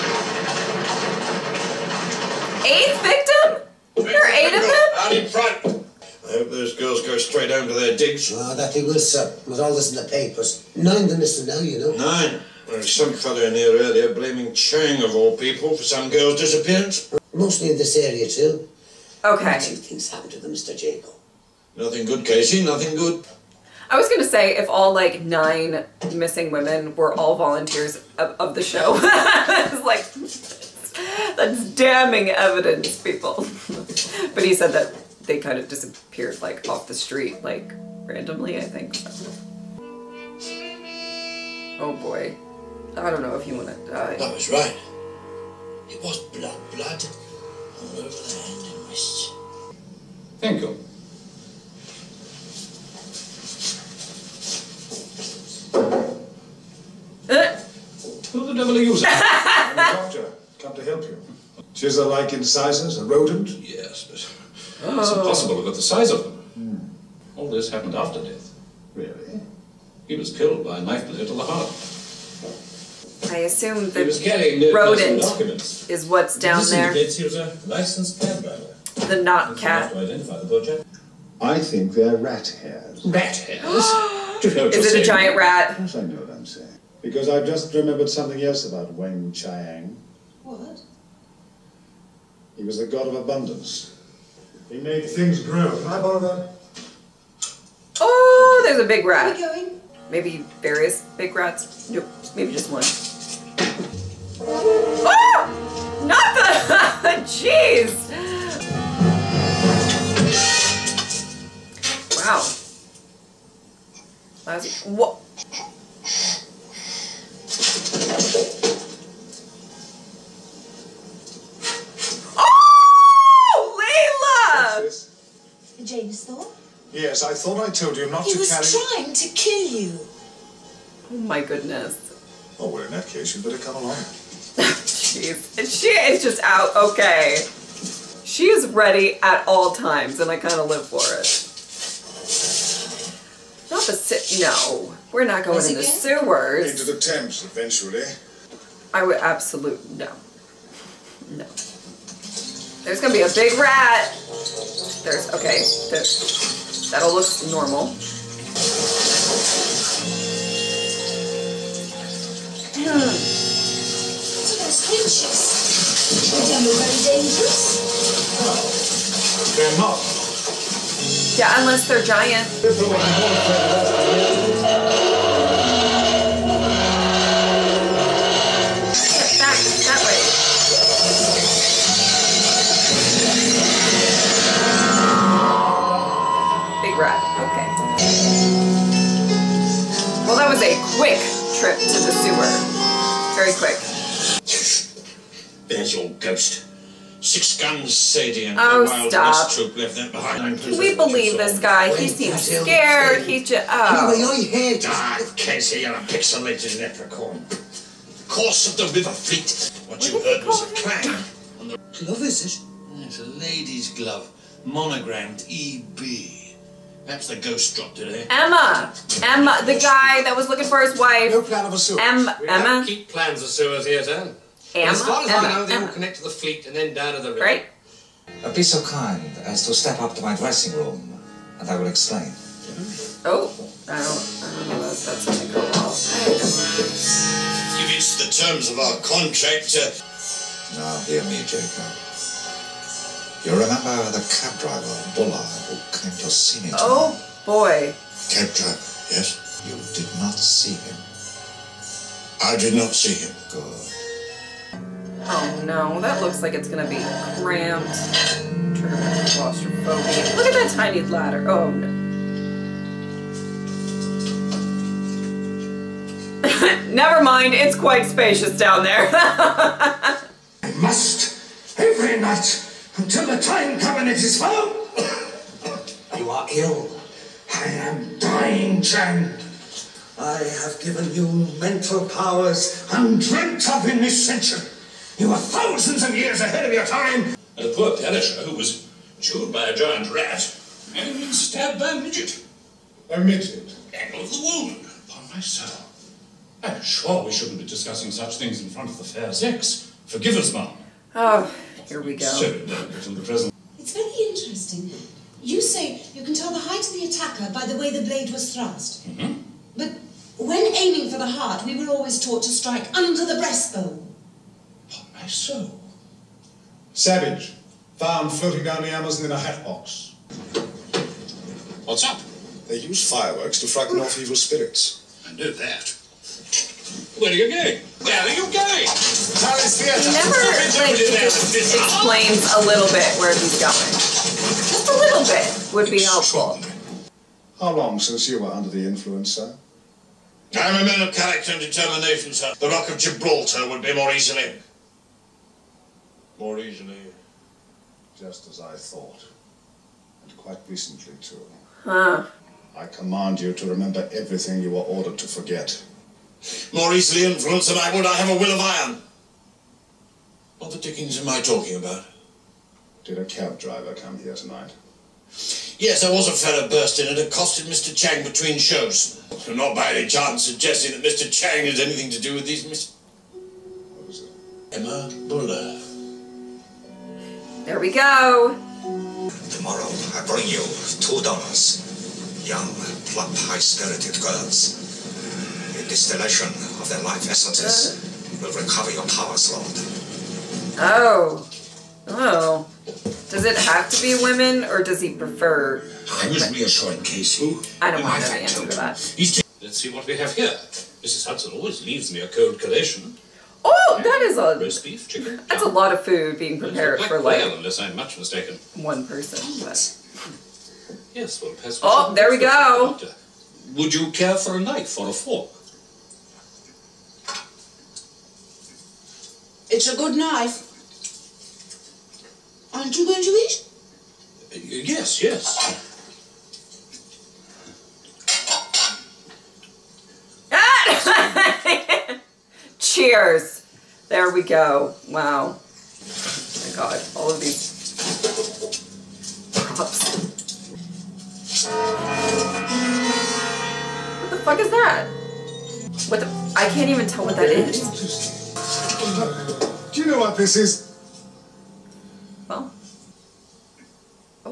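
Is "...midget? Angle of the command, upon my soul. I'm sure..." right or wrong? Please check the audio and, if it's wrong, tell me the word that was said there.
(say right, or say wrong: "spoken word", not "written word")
wrong: "wound", not "command".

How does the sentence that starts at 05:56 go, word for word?
More easily influenced than I would, I have a will of iron.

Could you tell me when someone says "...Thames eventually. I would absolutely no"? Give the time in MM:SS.
02:27.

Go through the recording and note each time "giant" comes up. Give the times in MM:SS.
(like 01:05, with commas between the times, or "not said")
01:25, 02:52, 04:49.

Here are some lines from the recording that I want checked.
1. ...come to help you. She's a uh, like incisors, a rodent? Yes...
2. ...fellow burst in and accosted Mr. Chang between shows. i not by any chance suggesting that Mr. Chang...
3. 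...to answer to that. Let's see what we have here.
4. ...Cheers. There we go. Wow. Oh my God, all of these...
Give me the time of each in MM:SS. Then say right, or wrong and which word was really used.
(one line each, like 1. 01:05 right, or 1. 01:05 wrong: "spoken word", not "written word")
1. 01:00 right
2. 06:06 right
3. 06:38 right
4. 07:12 right.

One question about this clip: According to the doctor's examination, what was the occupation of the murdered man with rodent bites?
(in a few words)
Licensed cab driver.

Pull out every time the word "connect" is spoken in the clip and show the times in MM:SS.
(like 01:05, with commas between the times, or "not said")
03:45.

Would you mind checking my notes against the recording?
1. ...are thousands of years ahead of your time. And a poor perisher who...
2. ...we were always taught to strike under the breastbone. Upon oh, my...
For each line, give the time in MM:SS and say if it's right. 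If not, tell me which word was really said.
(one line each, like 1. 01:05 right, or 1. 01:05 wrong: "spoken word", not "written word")
1. 04:45 right
2. 05:11 right.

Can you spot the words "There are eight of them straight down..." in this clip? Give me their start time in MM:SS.
00:03.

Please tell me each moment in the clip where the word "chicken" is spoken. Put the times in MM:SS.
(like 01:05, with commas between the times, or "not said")
06:45.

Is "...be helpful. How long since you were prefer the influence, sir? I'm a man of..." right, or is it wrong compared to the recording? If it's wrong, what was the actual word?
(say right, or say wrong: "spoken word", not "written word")
wrong: "under", not "prefer".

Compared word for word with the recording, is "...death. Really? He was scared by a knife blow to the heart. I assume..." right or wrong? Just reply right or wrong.
wrong.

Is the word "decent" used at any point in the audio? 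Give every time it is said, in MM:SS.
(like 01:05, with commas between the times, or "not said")
not said.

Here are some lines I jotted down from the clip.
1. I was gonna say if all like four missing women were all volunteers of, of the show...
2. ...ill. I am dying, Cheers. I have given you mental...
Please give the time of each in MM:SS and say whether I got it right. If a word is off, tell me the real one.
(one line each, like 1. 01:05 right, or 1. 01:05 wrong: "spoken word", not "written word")
1. 00:23 wrong: "nine", not "four"
2. 04:36 wrong: "Chang", not "Cheers".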